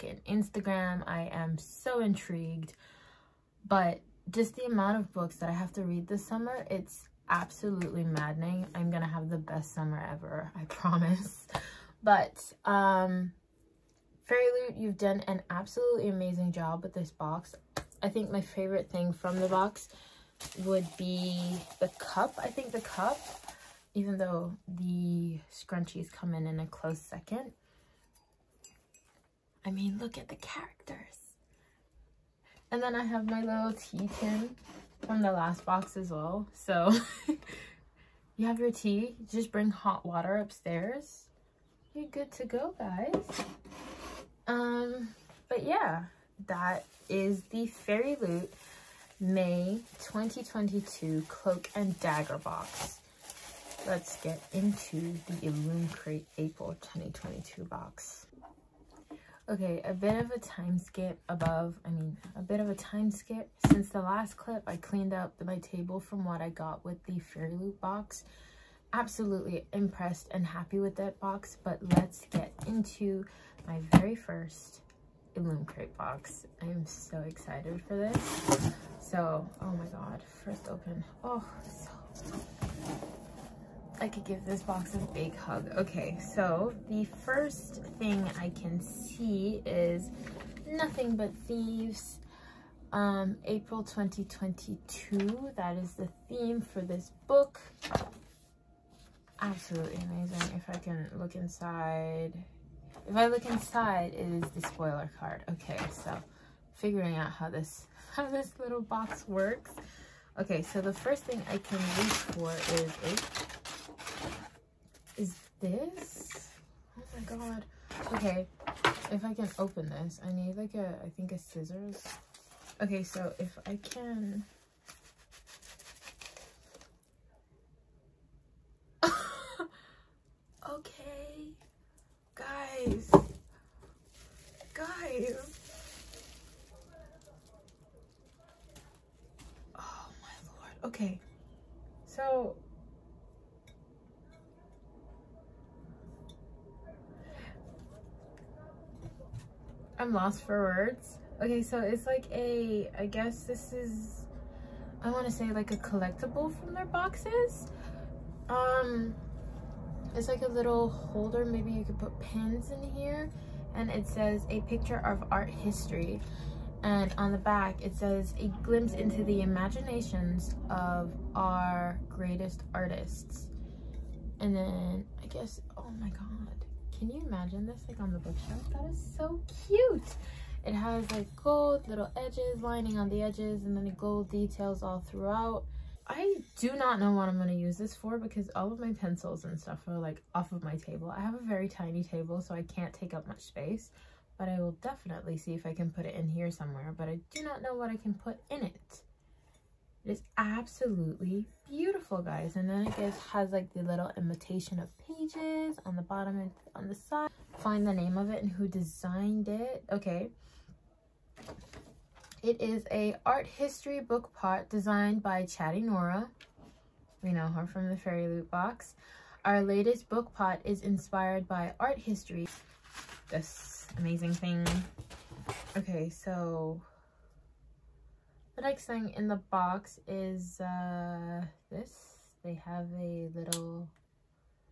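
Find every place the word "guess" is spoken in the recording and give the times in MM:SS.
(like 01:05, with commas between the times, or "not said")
02:33, 02:55.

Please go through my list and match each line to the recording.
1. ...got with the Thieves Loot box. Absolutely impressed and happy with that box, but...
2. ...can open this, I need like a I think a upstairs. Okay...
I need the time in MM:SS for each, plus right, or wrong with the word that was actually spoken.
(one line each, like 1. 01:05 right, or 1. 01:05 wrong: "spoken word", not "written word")
1. 01:06 wrong: "Fairy", not "Thieves"
2. 01:59 wrong: "scissors", not "upstairs".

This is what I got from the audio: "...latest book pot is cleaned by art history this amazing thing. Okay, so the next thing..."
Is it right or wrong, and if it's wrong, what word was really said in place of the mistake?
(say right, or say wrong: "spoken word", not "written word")
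wrong: "inspired", not "cleaned".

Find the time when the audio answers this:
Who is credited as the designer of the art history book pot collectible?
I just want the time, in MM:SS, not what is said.
03:35.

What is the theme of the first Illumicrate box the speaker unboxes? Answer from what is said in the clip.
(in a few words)
Nothing But Thieves.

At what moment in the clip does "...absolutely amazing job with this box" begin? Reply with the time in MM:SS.
00:15.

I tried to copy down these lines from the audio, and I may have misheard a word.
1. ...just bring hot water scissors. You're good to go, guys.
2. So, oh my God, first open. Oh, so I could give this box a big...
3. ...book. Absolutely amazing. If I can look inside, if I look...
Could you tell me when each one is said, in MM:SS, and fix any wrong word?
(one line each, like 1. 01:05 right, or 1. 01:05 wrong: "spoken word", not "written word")
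1. 00:39 wrong: "upstairs", not "scissors"
2. 01:19 right
3. 01:37 right.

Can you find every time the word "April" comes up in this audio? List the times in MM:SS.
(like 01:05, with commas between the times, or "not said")
00:56, 01:33.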